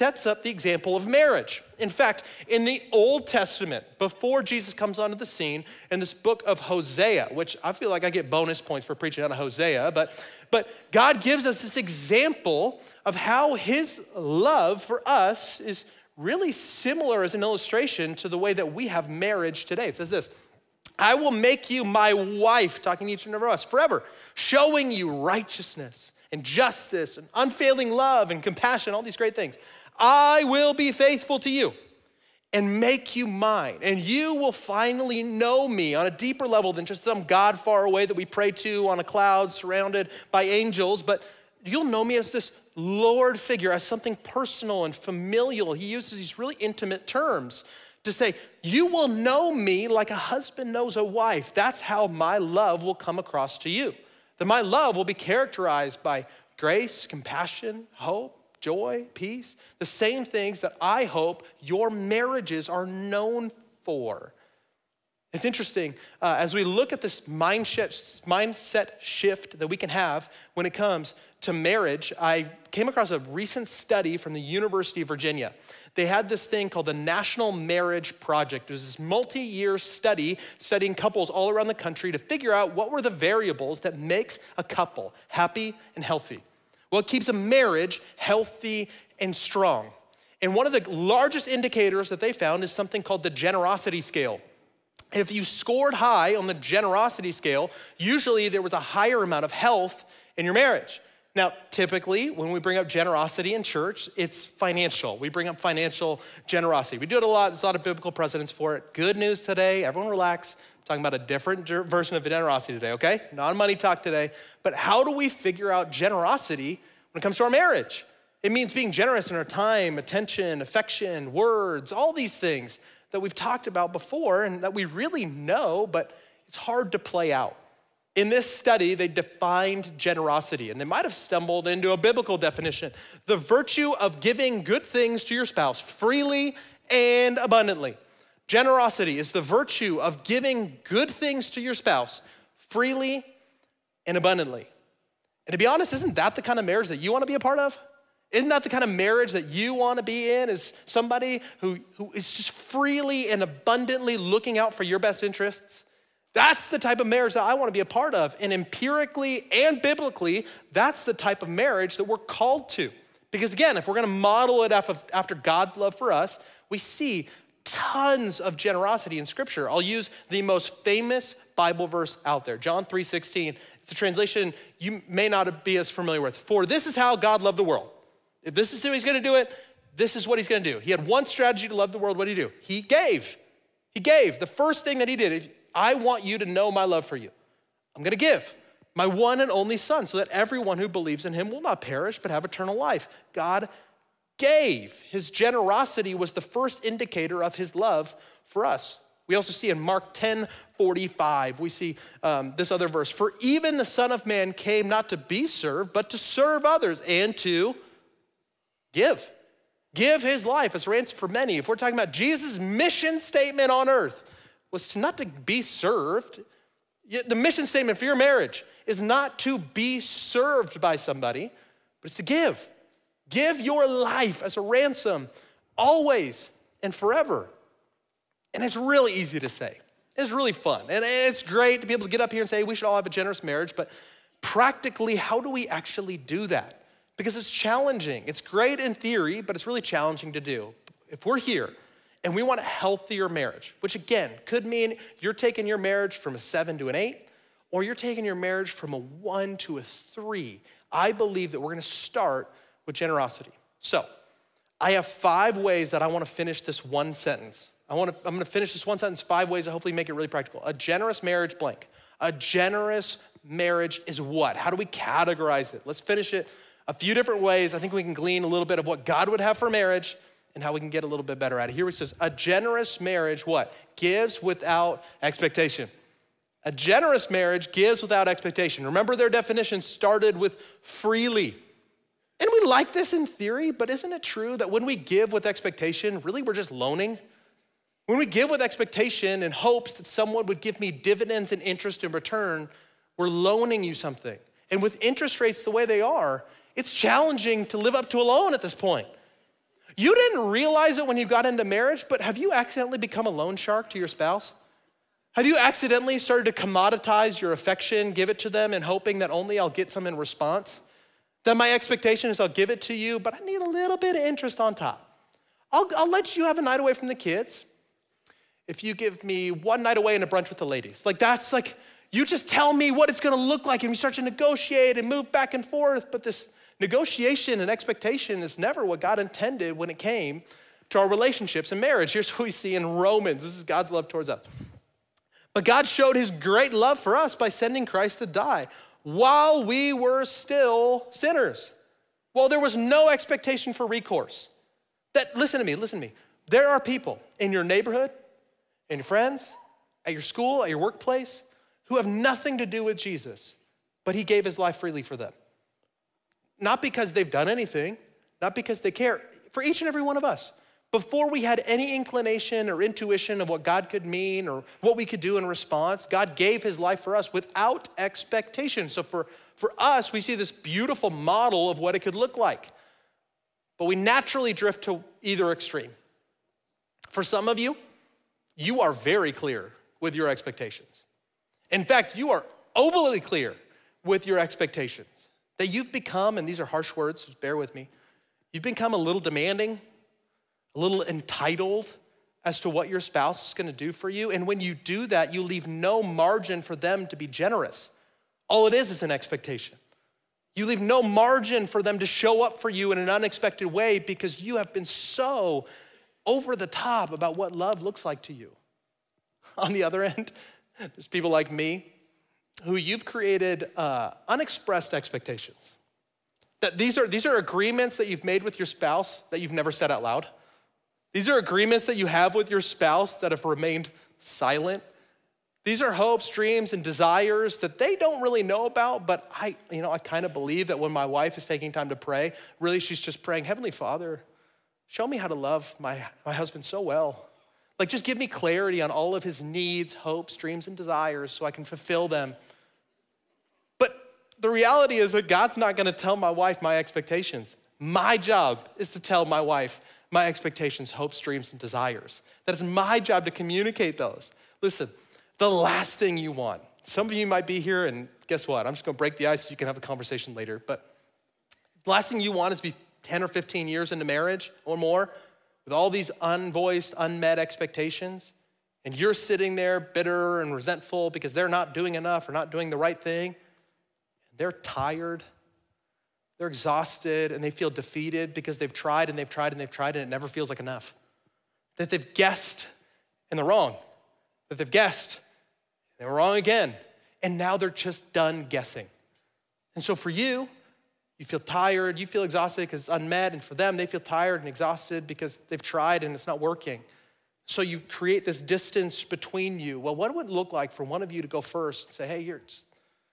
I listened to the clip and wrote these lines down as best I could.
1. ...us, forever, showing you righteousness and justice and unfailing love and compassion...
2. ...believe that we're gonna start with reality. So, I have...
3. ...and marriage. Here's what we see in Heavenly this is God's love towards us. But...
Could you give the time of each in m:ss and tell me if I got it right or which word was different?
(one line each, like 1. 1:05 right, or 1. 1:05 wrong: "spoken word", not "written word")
1. 0:23 right
2. 4:11 wrong: "generosity", not "reality"
3. 5:31 wrong: "Romans", not "Heavenly".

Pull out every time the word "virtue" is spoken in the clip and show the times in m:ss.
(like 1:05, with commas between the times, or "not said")
2:13, 2:19.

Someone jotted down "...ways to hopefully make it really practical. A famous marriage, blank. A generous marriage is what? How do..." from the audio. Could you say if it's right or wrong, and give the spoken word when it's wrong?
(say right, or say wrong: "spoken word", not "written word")
wrong: "generous", not "famous".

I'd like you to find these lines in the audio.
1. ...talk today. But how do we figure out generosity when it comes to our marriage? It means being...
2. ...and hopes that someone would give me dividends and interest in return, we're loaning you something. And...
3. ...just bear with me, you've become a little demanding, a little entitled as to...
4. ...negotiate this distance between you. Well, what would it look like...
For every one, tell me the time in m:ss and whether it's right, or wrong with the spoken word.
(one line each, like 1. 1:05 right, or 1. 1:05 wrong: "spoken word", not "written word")
1. 1:53 right
2. 4:49 right
3. 6:27 right
4. 8:17 wrong: "create", not "negotiate".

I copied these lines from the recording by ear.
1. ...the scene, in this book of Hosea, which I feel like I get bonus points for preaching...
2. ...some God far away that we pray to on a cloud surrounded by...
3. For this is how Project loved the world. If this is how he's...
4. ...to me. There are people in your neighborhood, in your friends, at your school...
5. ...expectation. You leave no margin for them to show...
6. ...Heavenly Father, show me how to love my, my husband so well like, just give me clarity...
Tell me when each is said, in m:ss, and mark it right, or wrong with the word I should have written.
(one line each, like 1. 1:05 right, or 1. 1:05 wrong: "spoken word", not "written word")
1. 0:05 right
2. 0:37 right
3. 2:56 wrong: "God", not "Project"
4. 5:46 right
5. 6:39 right
6. 7:13 right.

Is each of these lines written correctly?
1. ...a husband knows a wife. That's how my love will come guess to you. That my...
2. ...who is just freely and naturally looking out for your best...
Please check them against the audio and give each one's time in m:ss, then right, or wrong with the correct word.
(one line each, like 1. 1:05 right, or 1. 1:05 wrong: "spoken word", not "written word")
1. 0:50 wrong: "across", not "guess"
2. 2:31 wrong: "abundantly", not "naturally".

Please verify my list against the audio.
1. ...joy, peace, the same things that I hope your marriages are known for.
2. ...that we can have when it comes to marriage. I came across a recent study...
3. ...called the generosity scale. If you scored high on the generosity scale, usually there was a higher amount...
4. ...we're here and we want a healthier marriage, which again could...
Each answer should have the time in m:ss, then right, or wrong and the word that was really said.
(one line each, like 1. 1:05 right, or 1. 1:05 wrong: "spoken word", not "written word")
1. 0:58 right
2. 1:09 right
3. 1:33 right
4. 4:01 right.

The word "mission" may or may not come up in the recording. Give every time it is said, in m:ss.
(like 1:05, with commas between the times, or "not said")
3:32, 3:37.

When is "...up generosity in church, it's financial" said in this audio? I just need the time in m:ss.
1:42.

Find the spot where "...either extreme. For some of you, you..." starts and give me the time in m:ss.
6:15.